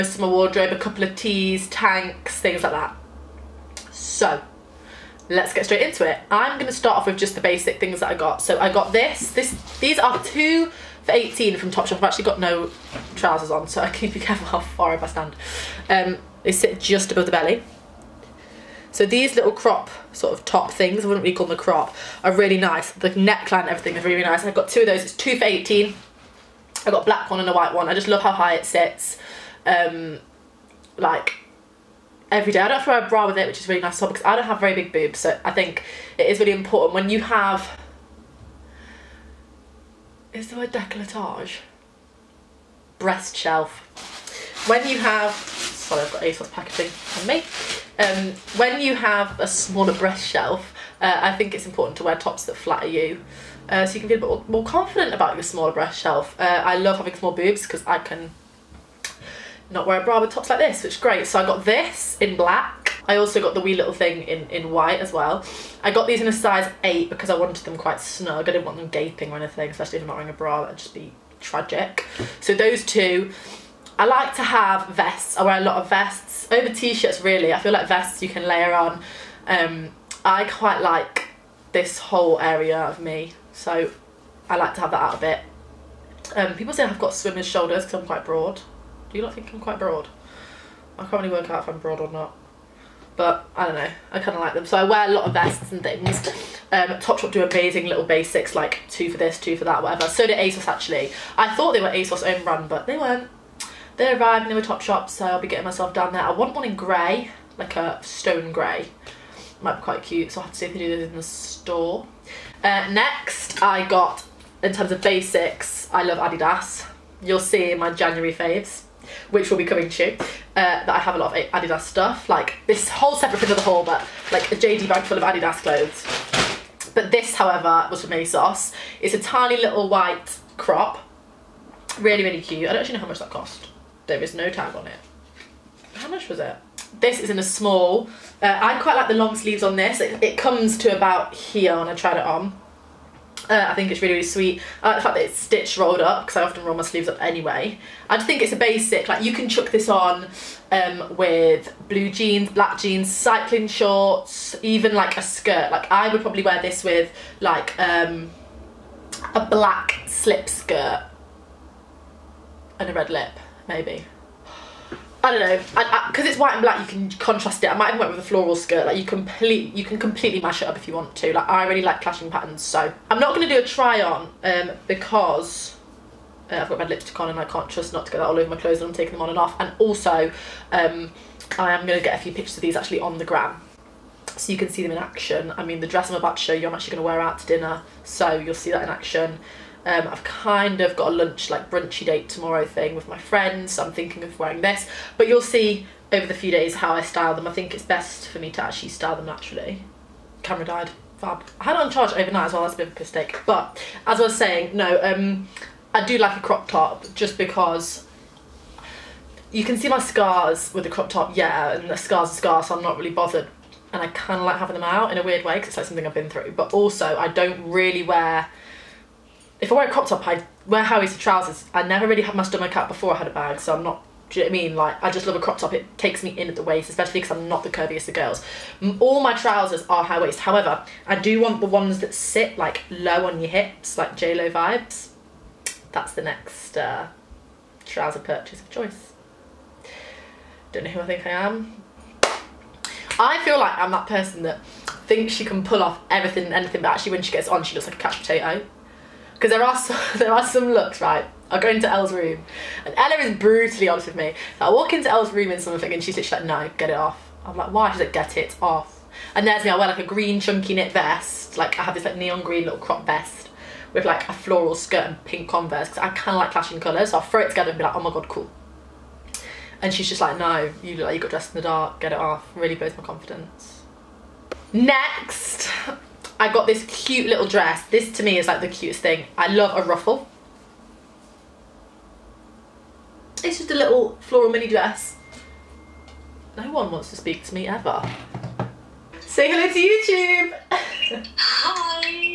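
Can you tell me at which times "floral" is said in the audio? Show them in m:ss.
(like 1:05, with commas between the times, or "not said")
2:48, 4:24, 4:44.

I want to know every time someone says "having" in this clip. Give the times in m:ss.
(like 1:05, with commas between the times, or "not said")
0:56, 3:34.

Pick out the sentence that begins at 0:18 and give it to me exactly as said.
So these little crop sort of top things, I wouldn't really call them a crop, are really nice.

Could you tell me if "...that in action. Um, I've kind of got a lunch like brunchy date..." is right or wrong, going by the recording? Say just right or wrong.
right.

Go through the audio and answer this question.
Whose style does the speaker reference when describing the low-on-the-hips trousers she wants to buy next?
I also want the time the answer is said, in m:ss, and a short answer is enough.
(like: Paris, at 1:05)
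J Lo, at 3:54.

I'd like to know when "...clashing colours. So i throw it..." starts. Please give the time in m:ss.
4:26.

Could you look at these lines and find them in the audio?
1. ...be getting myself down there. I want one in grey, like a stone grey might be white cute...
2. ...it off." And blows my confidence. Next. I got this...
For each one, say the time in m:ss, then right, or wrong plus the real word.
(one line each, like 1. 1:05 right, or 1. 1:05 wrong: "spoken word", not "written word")
1. 1:45 wrong: "quite", not "white"
2. 4:32 wrong: "Really", not "And".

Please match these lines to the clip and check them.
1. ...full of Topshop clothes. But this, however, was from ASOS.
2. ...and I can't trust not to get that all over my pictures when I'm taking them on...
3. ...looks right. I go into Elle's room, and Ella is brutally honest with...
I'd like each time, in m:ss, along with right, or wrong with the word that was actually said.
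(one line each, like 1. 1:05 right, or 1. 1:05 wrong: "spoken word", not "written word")
1. 2:05 wrong: "Adidas", not "Topshop"
2. 2:57 wrong: "clothes", not "pictures"
3. 4:10 right.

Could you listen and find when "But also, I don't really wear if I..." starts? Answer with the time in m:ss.
3:36.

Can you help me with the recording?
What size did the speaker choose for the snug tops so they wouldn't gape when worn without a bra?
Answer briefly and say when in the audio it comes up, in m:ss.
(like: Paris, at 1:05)
size 8, at 1:06.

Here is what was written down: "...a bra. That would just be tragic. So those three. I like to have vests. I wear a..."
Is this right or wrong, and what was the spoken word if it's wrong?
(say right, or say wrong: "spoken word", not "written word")
wrong: "two", not "three".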